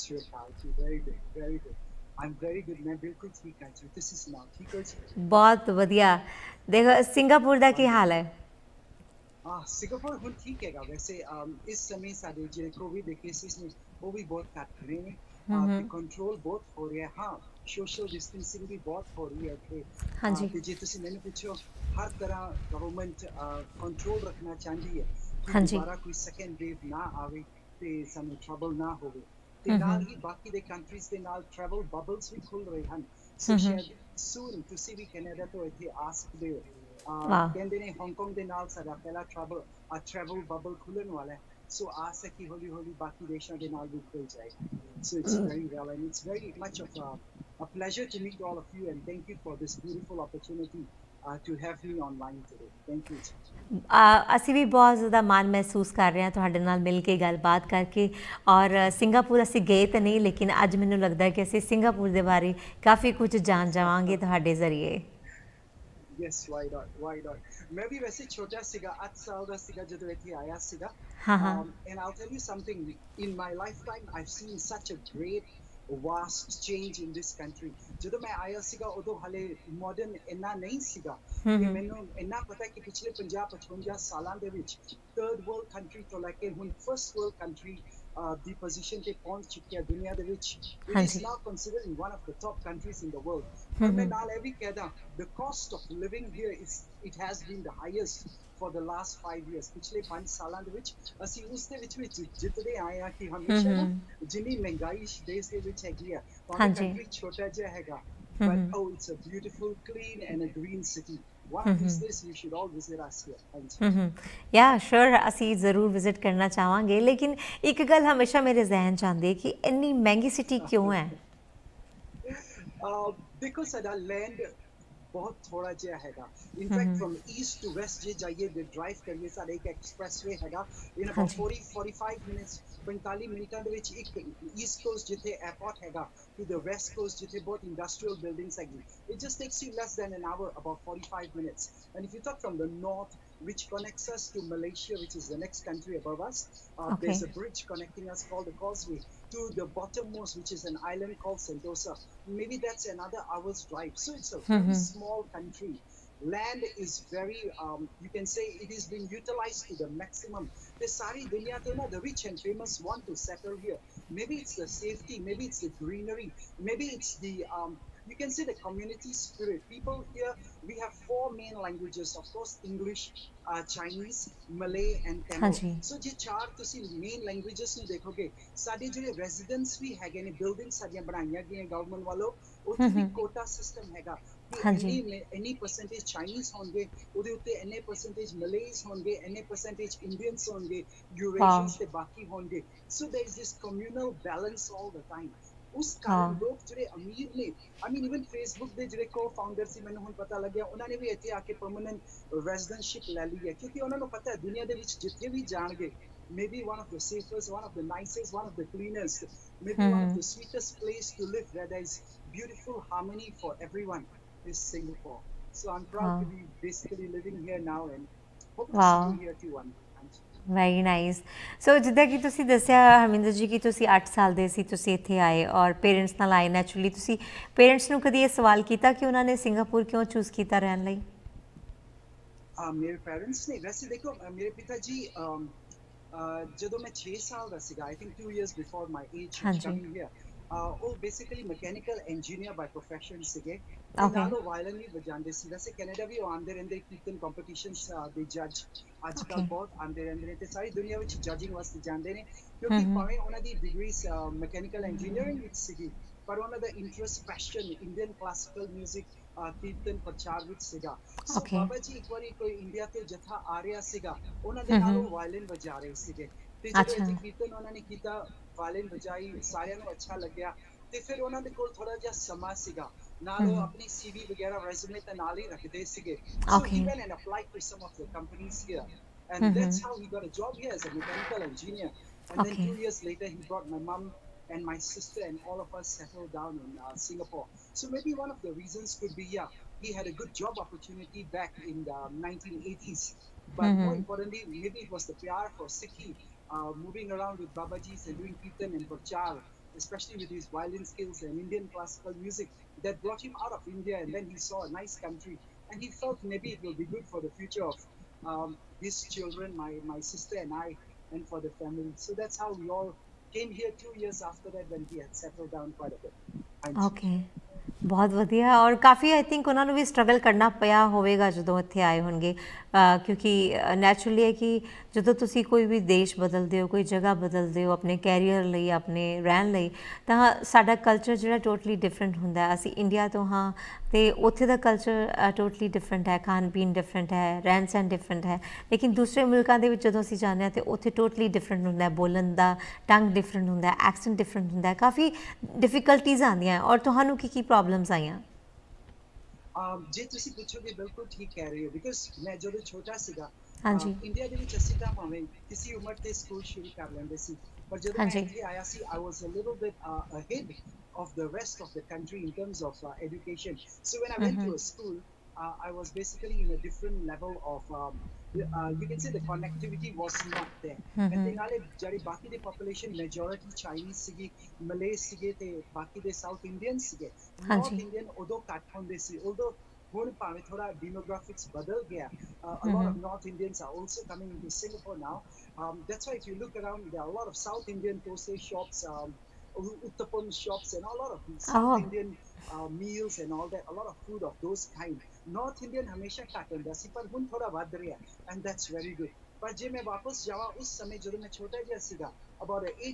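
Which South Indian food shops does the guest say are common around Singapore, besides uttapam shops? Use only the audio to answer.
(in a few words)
thosai shops.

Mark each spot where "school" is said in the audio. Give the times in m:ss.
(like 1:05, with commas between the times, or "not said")
6:04.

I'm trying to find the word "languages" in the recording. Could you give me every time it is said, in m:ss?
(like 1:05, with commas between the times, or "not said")
2:51, 2:57.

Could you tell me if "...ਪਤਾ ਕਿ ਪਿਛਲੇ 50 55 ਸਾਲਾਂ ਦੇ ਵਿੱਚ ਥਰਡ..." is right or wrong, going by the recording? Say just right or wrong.
right.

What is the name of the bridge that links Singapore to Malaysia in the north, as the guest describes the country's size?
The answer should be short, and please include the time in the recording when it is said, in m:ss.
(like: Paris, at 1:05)
the Causeway, at 2:28.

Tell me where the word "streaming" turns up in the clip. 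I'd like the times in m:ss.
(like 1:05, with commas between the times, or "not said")
not said.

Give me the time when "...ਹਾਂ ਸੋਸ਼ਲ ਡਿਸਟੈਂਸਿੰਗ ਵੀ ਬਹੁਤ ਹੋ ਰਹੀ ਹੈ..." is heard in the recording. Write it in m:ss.
0:17.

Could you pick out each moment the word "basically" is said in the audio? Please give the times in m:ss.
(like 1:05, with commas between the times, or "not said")
3:36, 4:00, 6:05.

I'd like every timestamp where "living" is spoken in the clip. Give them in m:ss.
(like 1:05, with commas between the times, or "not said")
3:37.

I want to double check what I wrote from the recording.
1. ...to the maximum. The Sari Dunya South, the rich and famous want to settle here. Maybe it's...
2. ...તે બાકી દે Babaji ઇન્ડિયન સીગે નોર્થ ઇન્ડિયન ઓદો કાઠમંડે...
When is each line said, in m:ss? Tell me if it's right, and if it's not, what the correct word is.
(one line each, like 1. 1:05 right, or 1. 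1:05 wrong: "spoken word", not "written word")
1. 2:39 wrong: "Tuna", not "South"
2. 6:15 wrong: "South", not "Babaji".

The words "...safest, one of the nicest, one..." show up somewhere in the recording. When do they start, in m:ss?
3:27.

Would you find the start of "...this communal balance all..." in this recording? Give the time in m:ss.
3:13.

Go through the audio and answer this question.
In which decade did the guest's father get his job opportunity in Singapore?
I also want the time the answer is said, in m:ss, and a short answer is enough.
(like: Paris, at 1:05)
1980s, at 4:52.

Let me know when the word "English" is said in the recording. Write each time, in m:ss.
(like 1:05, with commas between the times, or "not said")
2:52.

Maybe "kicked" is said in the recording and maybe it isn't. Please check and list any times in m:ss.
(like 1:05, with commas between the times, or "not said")
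not said.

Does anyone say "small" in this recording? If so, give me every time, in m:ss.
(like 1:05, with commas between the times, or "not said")
2:34.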